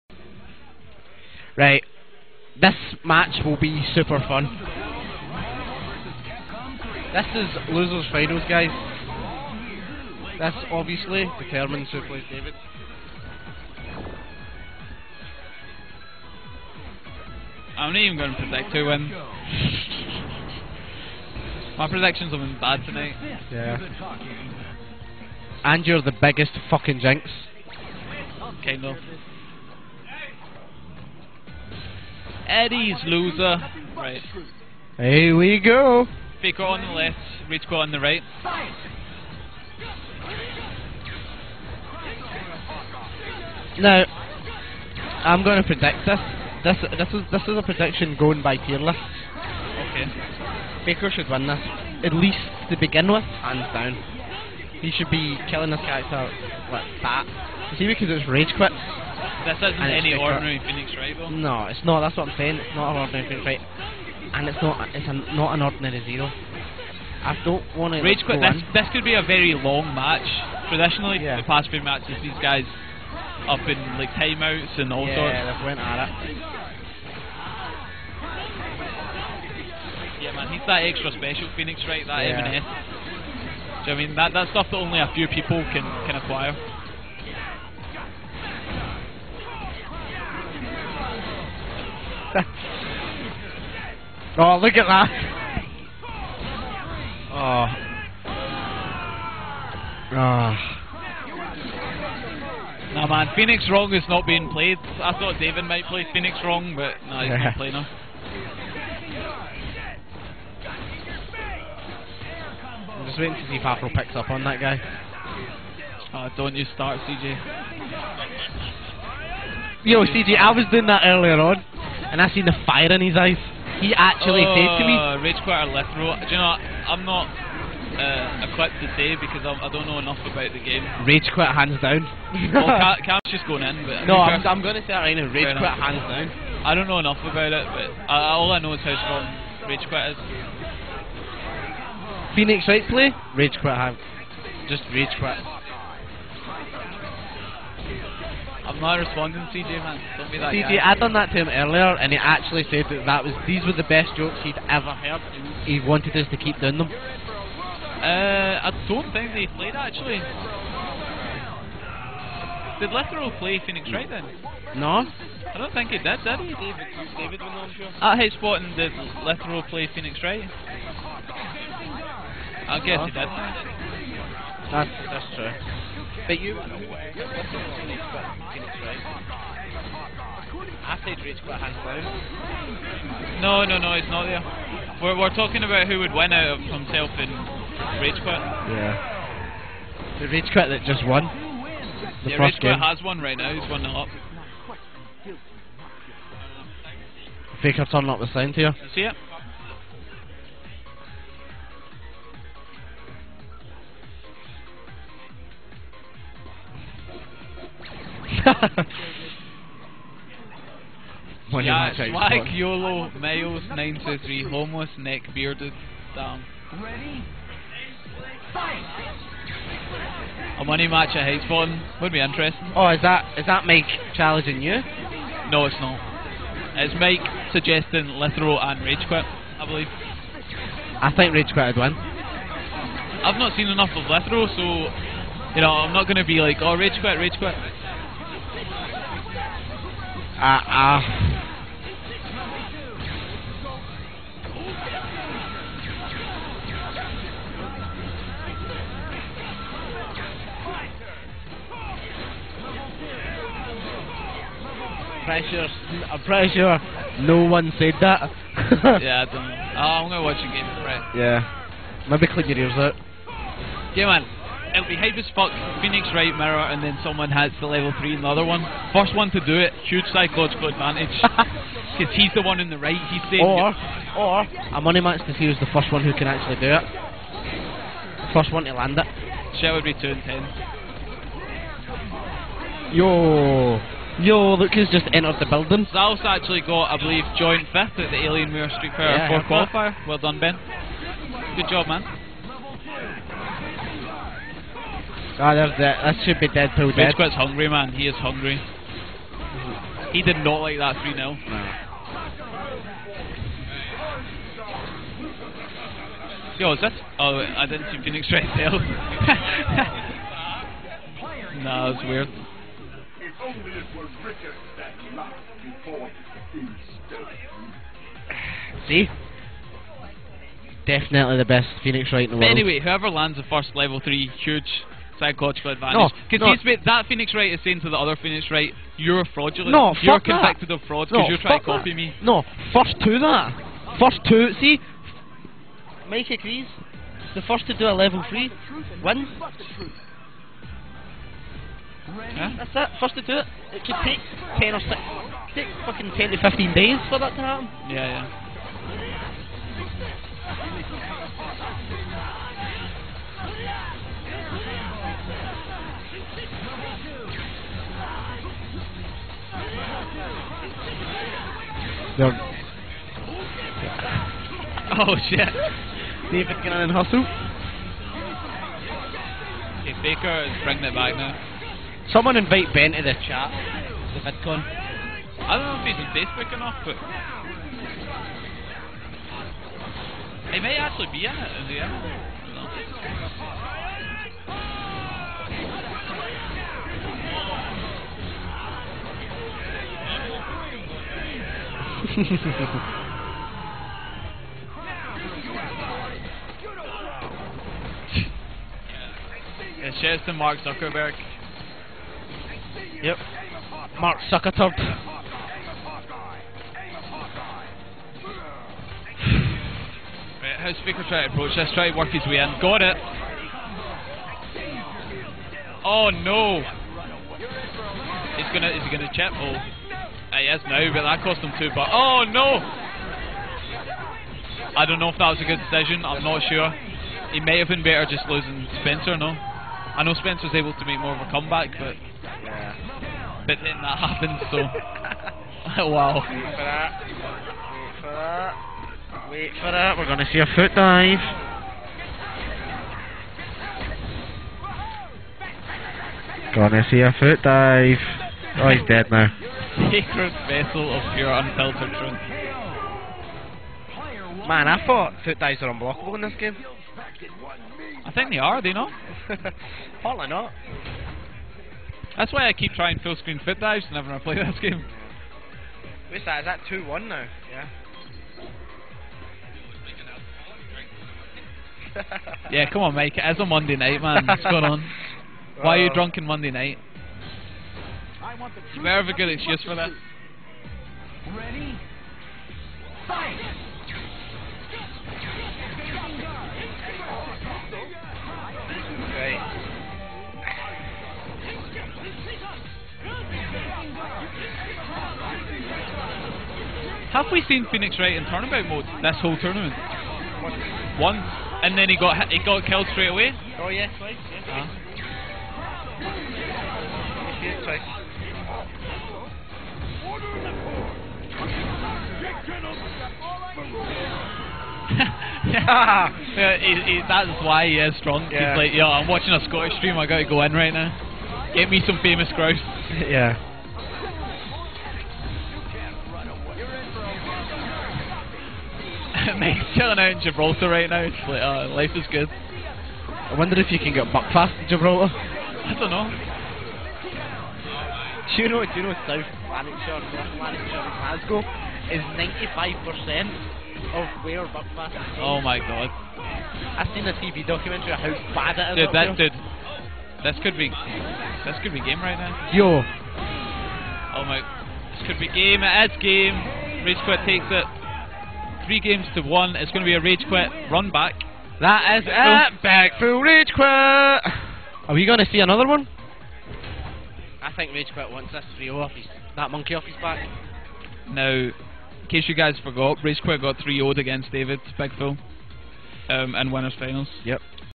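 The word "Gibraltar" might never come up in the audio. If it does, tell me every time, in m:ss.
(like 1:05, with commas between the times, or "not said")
8:50, 8:54.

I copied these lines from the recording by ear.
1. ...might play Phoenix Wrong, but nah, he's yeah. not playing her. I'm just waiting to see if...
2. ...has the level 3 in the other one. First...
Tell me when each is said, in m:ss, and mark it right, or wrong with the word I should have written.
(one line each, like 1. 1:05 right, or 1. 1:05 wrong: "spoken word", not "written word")
1. 1:45 right
2. 4:27 right.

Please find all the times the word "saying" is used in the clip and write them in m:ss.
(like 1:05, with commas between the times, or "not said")
1:02, 4:33, 5:27.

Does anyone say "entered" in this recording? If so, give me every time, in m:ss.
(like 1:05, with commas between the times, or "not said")
4:45.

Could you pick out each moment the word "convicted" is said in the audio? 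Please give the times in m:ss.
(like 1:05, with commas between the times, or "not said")
5:30.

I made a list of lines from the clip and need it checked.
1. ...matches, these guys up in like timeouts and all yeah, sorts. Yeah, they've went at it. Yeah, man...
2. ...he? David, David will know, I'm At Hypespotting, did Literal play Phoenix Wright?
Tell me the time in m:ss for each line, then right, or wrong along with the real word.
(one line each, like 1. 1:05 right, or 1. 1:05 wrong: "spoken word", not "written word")
1. 1:11 right
2. 2:46 right.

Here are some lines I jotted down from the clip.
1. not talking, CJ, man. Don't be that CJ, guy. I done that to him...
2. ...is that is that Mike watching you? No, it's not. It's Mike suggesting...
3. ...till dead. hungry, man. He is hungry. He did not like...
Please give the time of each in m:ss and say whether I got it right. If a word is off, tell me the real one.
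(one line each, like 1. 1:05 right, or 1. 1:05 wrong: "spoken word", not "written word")
1. 2:28 wrong: "responding", not "talking"
2. 3:42 wrong: "challenging", not "watching"
3. 4:56 right.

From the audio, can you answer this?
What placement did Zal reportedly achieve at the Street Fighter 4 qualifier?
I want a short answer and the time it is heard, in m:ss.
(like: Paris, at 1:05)
joint fifth, at 4:47.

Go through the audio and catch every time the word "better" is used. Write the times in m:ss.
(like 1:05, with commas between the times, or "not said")
7:07.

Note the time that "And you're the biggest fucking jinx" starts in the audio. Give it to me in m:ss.
0:25.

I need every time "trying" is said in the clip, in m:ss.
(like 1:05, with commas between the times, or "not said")
5:31, 7:42.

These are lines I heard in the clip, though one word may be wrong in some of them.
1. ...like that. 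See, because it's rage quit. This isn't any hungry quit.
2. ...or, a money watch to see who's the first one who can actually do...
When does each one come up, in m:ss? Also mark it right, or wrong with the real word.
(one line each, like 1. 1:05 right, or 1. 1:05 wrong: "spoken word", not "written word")
1. 0:56 wrong: "ordinary", not "hungry"
2. 4:34 wrong: "match", not "watch".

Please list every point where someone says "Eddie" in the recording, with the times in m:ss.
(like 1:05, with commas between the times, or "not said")
0:32.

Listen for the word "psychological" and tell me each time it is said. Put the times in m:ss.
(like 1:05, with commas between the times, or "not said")
4:30, 5:25.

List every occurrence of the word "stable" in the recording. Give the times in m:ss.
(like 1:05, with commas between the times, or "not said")
not said.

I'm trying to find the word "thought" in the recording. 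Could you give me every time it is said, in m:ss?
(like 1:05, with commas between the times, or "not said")
1:45, 7:34.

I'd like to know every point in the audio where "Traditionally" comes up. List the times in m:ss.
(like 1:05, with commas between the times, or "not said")
1:10.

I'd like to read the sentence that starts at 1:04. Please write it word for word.
It's a, not an ordinary zero.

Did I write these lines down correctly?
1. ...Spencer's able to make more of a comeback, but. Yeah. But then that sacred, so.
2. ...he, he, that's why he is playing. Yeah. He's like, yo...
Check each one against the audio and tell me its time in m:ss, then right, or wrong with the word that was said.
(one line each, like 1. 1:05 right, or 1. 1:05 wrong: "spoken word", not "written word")
1. 7:10 wrong: "happened", not "sacred"
2. 8:36 wrong: "strong", not "playing".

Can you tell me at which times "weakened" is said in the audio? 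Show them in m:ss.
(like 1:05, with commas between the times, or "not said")
not said.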